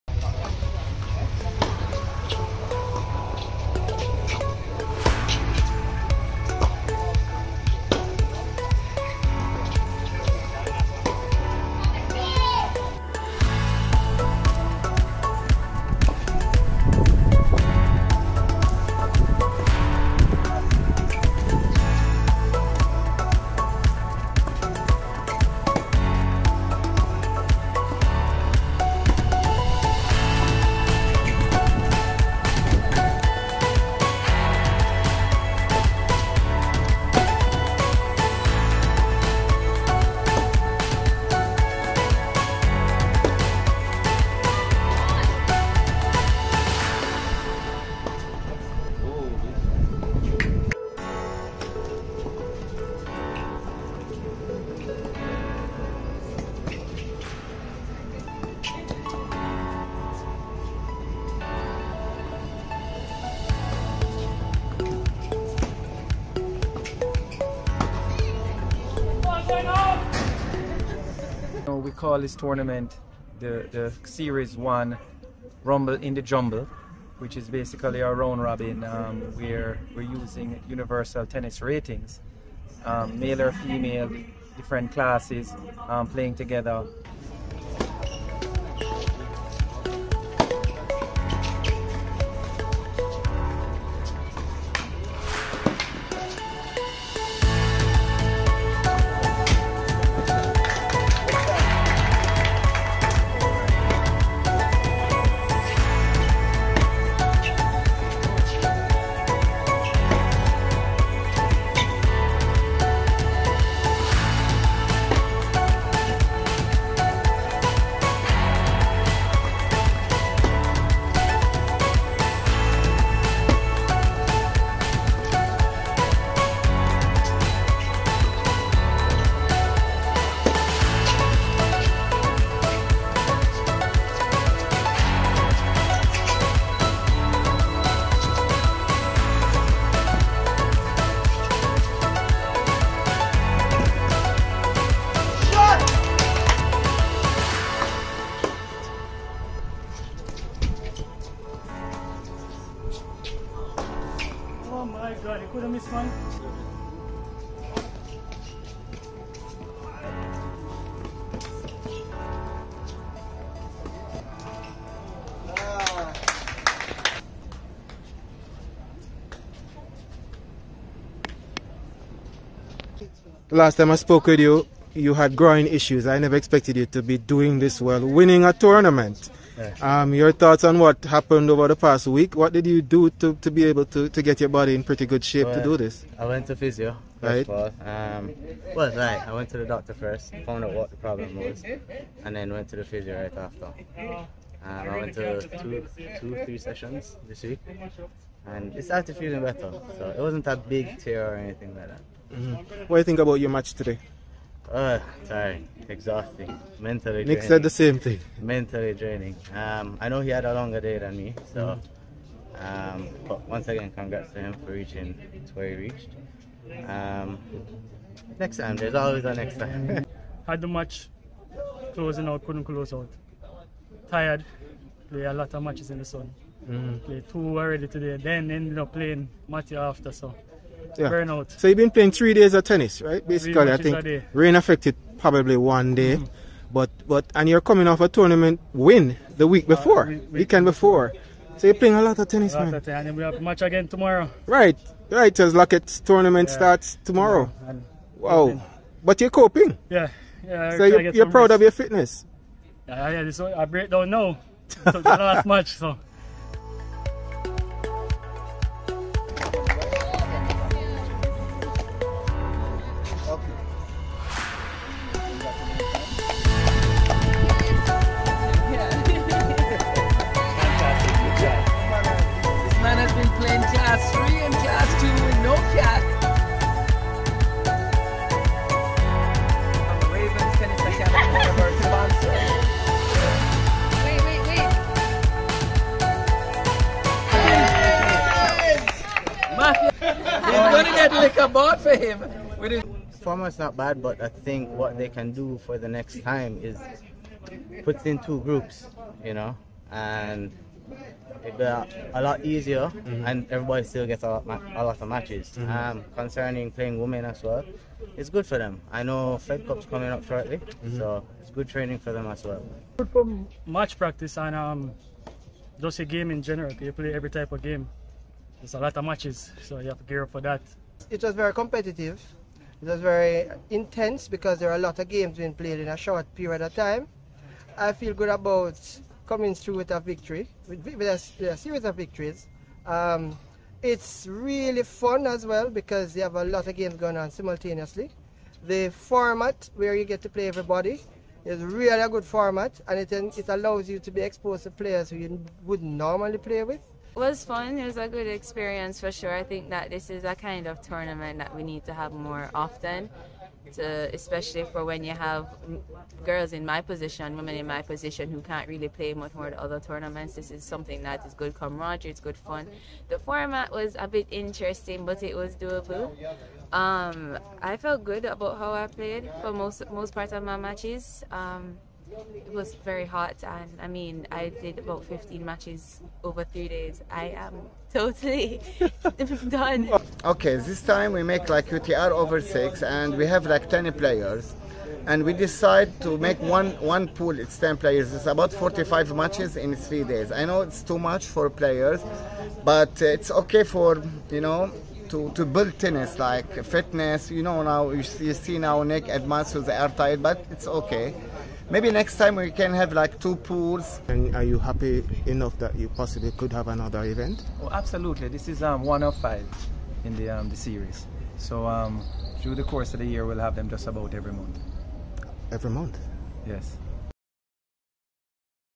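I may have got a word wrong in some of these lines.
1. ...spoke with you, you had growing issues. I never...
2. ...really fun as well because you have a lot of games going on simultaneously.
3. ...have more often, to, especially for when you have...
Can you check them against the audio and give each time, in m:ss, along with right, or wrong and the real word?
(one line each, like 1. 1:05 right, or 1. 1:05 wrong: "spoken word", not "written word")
1. 2:53 right
2. 5:34 right
3. 5:51 right.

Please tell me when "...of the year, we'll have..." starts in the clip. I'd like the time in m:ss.
6:52.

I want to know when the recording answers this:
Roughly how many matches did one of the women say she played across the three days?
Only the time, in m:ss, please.
6:15.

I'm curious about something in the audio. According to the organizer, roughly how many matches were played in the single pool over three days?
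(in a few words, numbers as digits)
45.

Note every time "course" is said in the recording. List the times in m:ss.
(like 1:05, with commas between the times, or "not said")
6:52.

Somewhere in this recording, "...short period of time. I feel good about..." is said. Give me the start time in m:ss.
5:25.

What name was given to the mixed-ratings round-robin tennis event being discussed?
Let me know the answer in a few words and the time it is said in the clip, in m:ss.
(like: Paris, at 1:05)
Rumble in the Jumble, at 1:15.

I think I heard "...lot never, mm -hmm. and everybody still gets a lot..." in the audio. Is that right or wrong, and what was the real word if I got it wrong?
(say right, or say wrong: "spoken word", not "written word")
wrong: "easier", not "never".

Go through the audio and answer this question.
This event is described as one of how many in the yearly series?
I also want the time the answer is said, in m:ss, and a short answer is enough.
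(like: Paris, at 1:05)
5, at 6:49.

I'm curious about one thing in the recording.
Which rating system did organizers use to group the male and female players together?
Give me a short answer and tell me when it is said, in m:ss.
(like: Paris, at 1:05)
Universal Tennis Ratings, at 1:20.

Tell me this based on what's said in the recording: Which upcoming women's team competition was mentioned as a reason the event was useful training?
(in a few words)
Fed Cup.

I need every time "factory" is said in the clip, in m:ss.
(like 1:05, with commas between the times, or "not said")
not said.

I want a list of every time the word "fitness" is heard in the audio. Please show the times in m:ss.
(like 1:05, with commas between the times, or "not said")
4:11, 6:36.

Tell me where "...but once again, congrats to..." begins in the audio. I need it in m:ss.
3:33.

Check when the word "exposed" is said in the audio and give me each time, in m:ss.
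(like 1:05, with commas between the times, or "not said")
5:44.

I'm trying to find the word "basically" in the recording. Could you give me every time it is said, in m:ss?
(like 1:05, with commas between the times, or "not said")
1:17, 3:53.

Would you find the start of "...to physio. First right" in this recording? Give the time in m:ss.
3:06.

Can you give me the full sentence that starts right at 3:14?
Uh, I went to two, two, three sessions this week, and it started feeling better.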